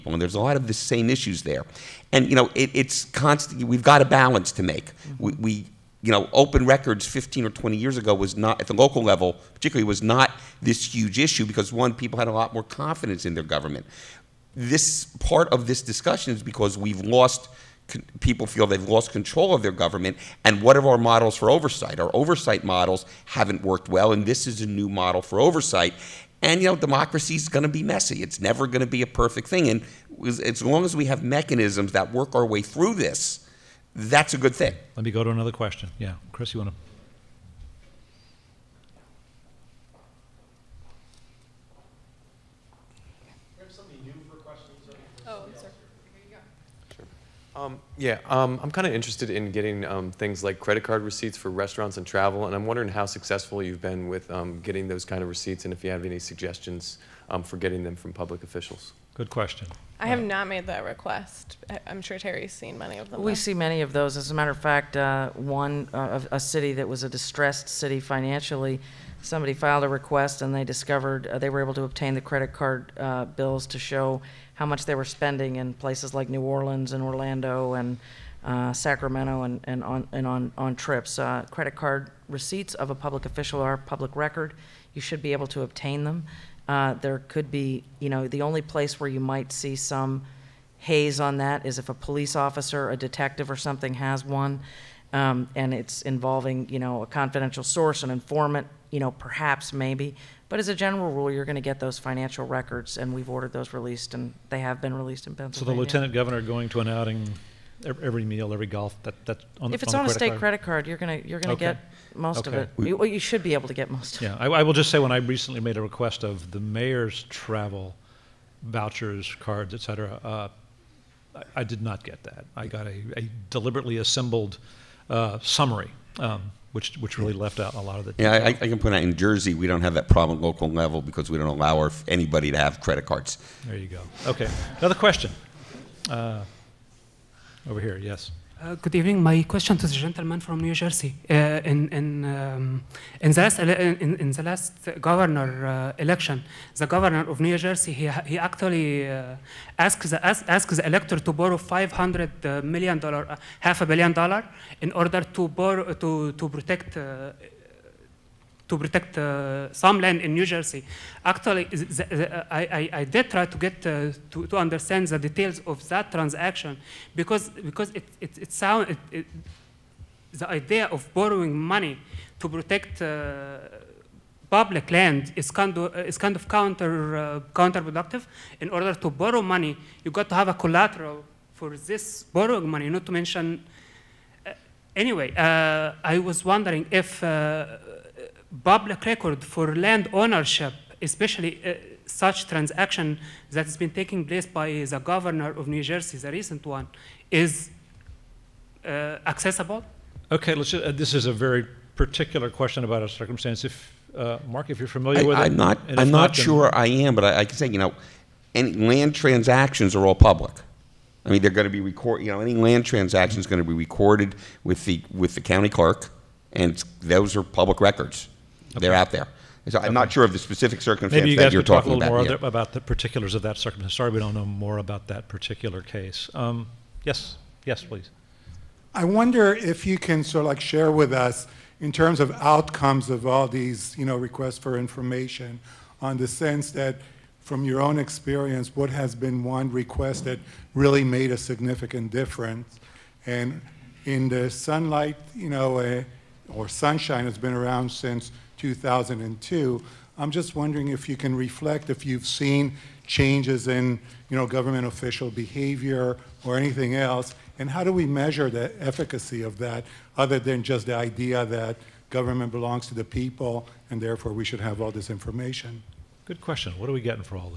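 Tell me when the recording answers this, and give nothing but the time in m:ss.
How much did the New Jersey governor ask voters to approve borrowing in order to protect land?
2:31.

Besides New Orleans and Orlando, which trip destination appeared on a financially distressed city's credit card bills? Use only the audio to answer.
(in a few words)
Sacramento.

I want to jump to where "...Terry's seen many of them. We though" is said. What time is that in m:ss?
1:02.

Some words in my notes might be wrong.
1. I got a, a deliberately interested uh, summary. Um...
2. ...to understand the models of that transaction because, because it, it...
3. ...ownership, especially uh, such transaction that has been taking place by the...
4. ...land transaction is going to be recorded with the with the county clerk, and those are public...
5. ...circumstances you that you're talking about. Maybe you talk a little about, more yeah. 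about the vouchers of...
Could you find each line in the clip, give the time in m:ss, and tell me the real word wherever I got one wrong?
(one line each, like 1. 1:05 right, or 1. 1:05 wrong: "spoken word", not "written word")
1. 2:02 wrong: "assembled", not "interested"
2. 2:44 wrong: "details", not "models"
3. 3:10 right
4. 3:32 right
5. 3:40 wrong: "particulars", not "vouchers".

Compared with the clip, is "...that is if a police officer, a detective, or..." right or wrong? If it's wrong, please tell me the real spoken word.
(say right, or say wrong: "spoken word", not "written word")
right.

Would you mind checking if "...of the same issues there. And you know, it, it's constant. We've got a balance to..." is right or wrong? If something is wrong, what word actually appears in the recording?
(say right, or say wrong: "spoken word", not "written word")
right.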